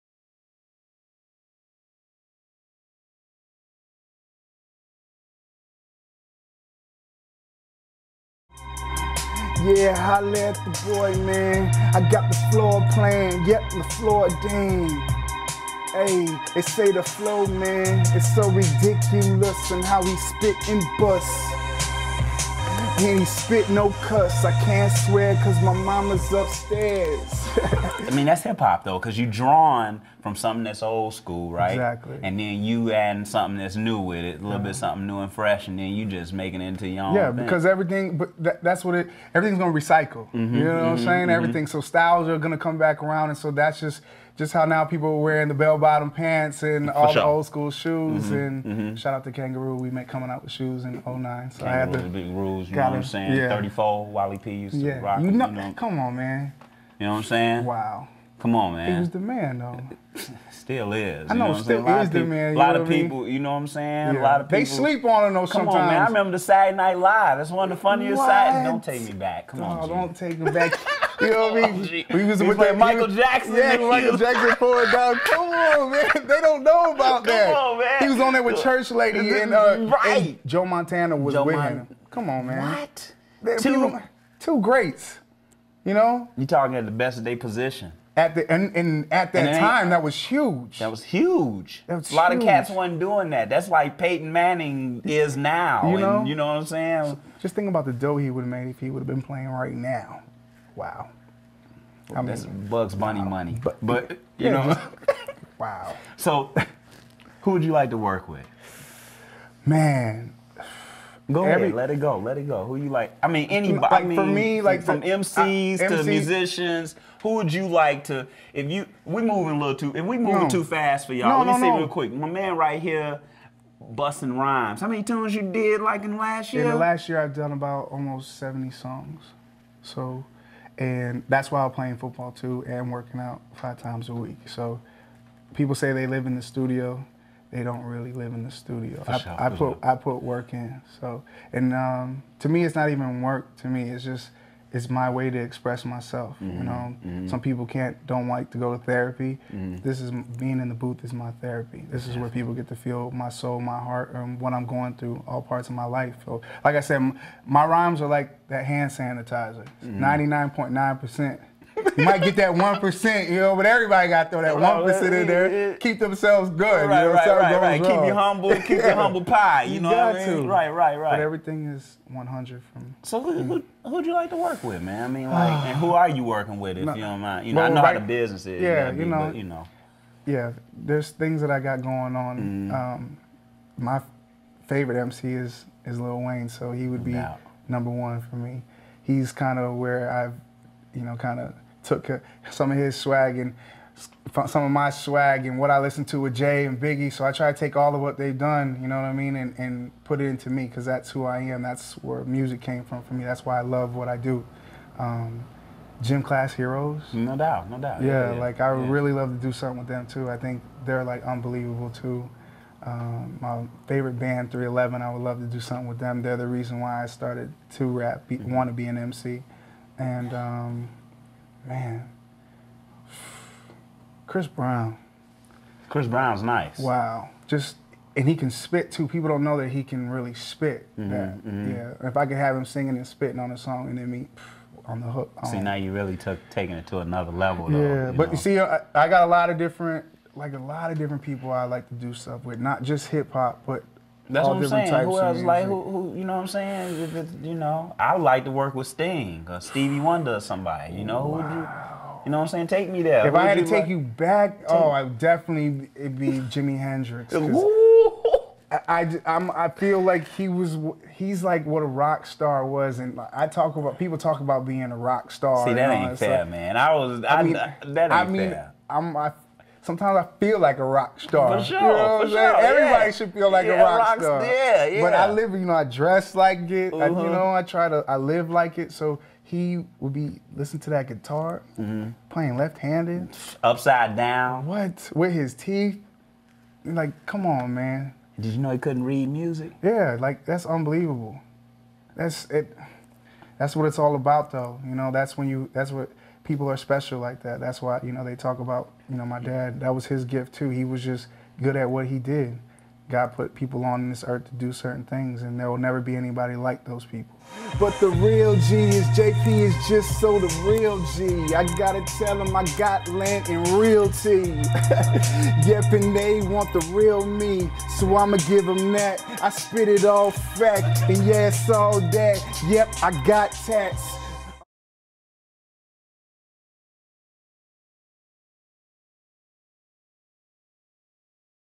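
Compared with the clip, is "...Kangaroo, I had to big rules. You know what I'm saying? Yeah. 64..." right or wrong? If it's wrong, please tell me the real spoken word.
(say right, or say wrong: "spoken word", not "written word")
wrong: "34", not "64".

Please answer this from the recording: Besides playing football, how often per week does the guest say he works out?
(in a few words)
5 times.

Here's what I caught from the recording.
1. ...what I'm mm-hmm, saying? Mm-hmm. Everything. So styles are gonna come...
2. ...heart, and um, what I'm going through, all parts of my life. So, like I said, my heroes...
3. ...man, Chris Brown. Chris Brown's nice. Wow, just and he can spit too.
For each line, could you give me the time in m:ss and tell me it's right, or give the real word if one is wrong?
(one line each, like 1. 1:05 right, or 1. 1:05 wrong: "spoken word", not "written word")
1. 0:40 right
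2. 2:33 wrong: "rhymes", not "heroes"
3. 3:41 right.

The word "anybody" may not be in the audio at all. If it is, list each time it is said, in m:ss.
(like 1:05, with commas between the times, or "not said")
1:53, 5:06.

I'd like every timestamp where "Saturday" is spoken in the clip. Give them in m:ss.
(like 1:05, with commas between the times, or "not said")
1:06.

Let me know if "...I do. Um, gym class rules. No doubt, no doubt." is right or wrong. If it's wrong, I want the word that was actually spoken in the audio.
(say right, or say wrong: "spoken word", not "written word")
wrong: "heroes", not "rules".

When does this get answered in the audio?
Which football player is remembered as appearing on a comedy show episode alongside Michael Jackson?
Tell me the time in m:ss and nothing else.
1:20.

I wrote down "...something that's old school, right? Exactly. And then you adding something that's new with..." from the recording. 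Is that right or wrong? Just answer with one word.
right.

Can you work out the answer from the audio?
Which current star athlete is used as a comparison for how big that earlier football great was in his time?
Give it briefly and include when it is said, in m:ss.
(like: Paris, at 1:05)
Peyton Manning, at 1:33.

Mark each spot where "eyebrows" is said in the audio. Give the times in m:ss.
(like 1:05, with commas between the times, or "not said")
not said.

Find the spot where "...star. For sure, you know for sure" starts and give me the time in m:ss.
4:31.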